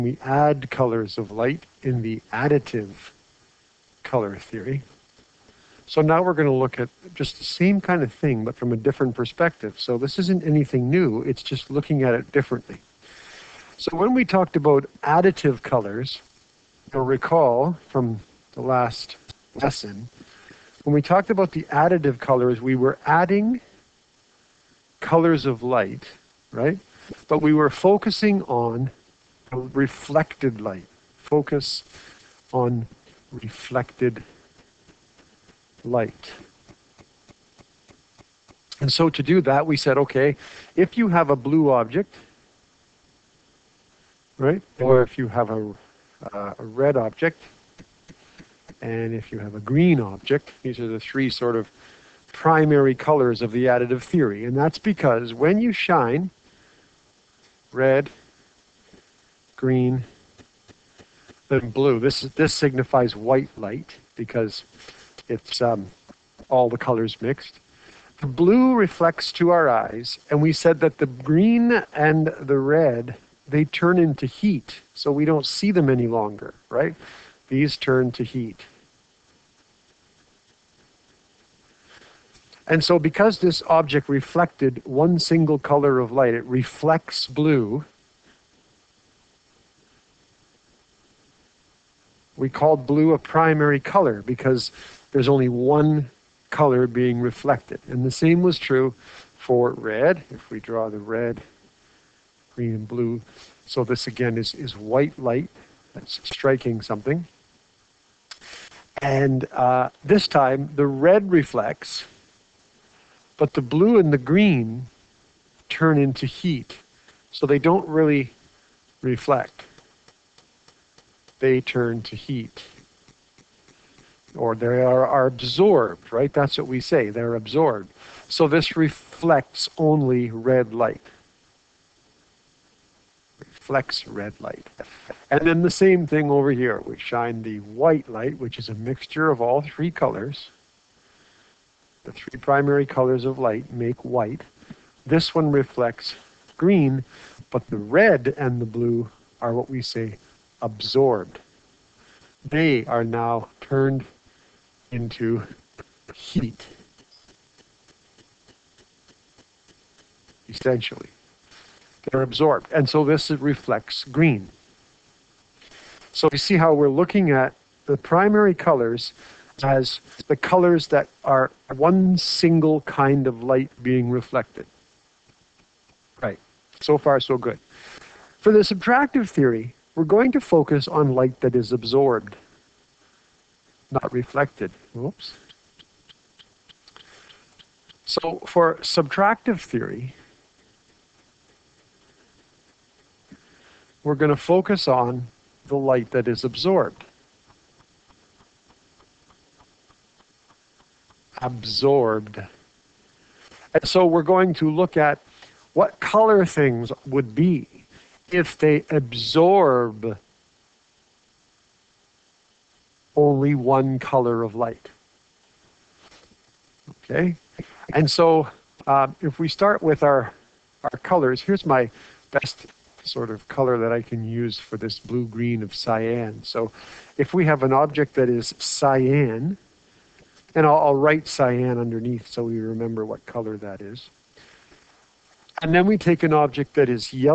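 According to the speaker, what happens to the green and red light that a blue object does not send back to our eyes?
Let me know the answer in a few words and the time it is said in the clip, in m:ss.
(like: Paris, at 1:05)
They turn into heat, at 1:13.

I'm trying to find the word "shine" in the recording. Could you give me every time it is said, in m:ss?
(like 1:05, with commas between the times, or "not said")
0:55, 2:16.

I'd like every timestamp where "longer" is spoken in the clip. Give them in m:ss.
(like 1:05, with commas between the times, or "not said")
1:16.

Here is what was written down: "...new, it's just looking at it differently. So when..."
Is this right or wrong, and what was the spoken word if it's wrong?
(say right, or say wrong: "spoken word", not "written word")
right.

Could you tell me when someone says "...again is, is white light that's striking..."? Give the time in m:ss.
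1:44.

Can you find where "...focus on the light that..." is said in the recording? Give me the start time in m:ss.
3:14.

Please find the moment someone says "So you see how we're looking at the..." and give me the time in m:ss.
2:46.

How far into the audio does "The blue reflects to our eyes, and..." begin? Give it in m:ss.
1:08.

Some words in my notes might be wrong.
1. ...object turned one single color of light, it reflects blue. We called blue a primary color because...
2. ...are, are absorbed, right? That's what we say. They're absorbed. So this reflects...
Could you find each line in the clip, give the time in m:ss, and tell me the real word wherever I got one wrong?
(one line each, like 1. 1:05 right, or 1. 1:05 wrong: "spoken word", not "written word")
1. 1:23 wrong: "reflected", not "turned"
2. 2:04 right.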